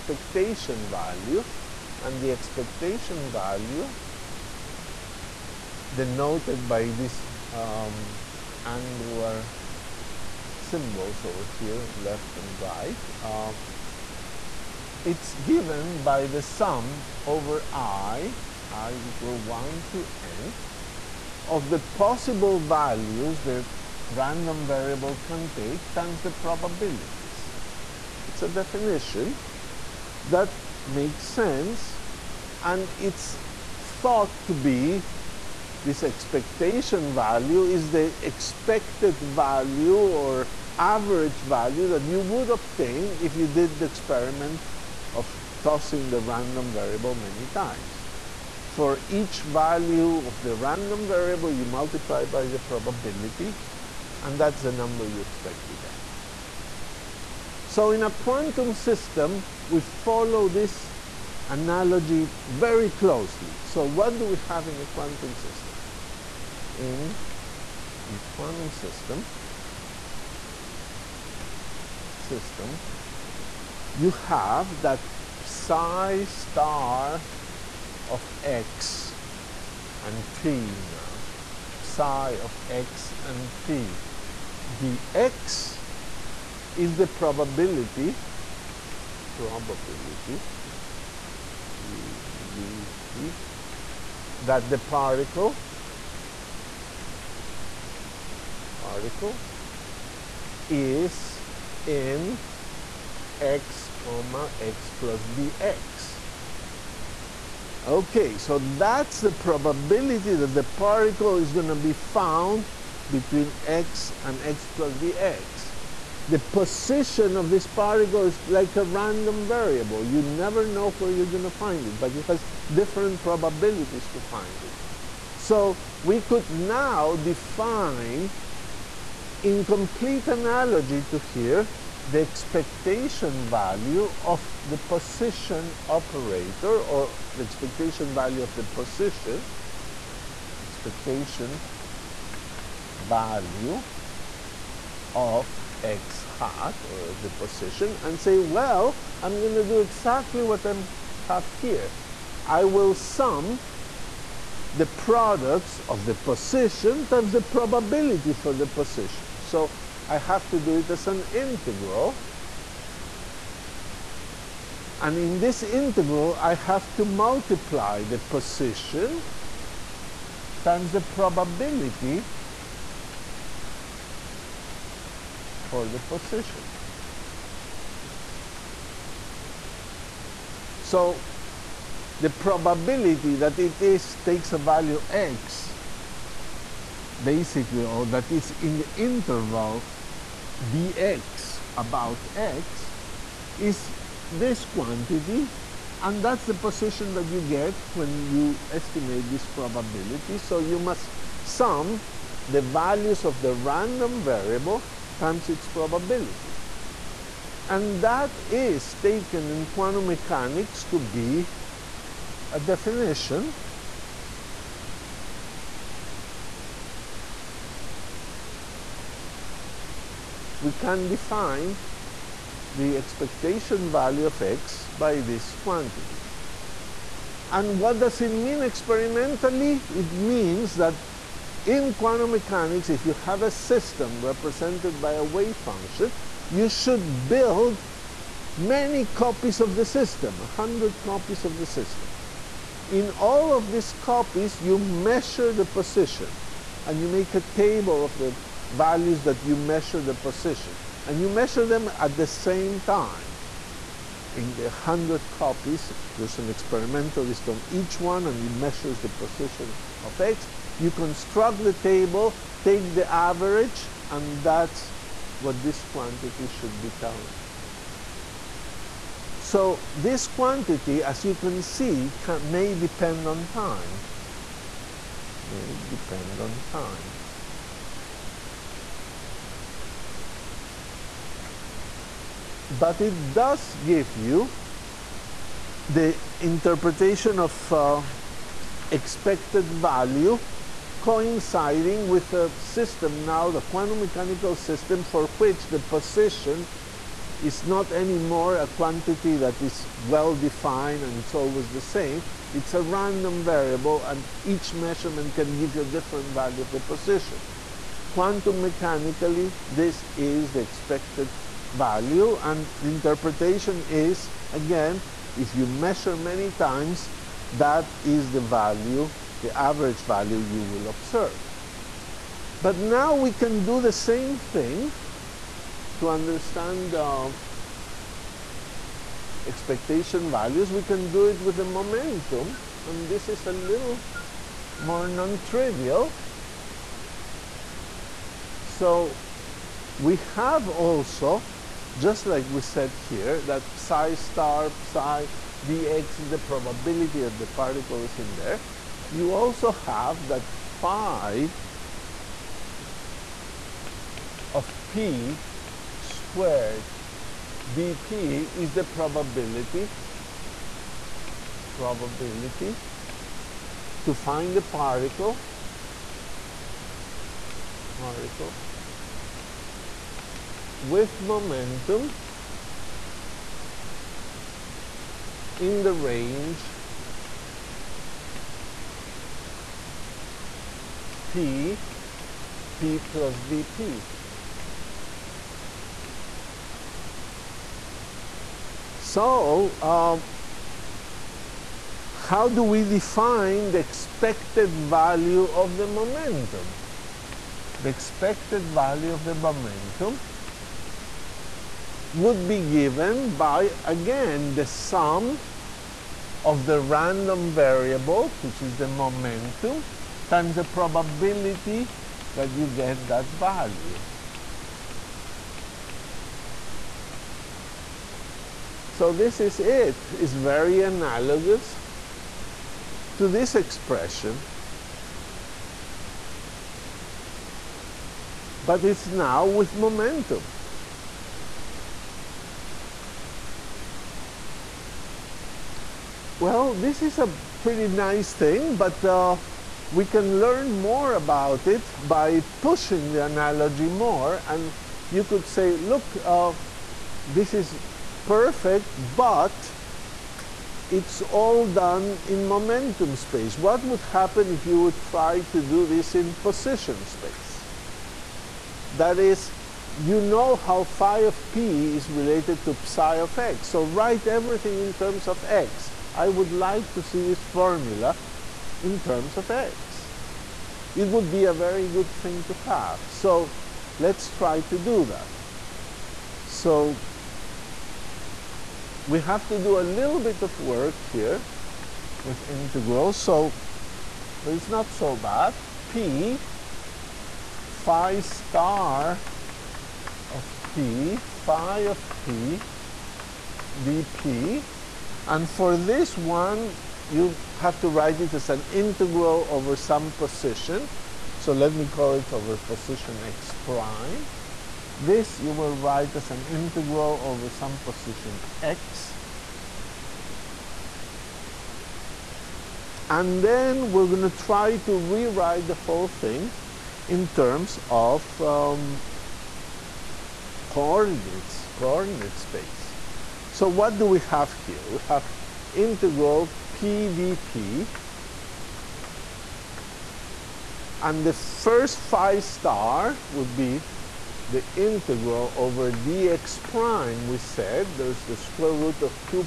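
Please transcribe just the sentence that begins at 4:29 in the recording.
So this quantity, as you can see, can, may depend on time.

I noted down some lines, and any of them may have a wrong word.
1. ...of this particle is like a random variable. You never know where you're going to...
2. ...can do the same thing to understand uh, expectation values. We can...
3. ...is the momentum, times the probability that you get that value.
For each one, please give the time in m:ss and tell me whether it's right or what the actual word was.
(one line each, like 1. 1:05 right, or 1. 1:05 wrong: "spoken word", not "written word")
1. 1:57 right
2. 5:23 right
3. 6:48 right.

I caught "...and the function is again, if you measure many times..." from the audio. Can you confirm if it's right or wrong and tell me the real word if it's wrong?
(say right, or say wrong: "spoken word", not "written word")
wrong: "interpretation", not "function".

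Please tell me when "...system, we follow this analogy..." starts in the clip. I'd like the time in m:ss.
0:58.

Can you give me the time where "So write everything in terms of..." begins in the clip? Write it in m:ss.
7:43.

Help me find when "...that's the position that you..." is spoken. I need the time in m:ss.
3:16.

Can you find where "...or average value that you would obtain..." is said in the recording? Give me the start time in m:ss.
0:39.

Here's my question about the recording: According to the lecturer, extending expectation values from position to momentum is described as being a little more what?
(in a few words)
non-trivial.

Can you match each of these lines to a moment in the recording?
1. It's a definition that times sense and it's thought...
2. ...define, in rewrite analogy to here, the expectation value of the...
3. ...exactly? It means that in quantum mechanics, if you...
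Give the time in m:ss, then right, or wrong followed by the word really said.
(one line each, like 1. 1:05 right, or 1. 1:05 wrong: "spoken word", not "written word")
1. 0:28 wrong: "makes", not "times"
2. 2:07 wrong: "complete", not "rewrite"
3. 3:48 wrong: "experimentally", not "exactly".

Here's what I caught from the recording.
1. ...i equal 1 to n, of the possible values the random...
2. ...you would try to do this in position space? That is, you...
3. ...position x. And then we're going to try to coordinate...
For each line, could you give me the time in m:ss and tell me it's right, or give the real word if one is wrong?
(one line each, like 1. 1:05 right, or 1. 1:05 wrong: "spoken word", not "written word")
1. 0:18 right
2. 7:34 right
3. 8:27 wrong: "rewrite", not "coordinate".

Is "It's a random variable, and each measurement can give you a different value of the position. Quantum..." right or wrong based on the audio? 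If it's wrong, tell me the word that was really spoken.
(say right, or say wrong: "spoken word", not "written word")
right.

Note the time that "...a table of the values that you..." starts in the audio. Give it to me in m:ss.
4:07.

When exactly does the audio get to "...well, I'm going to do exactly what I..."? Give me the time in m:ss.
2:28.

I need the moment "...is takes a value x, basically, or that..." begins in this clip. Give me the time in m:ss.
3:03.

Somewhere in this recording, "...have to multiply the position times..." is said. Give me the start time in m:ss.
2:46.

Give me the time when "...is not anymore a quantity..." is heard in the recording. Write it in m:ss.
4:57.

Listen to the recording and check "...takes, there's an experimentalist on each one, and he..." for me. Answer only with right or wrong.
wrong.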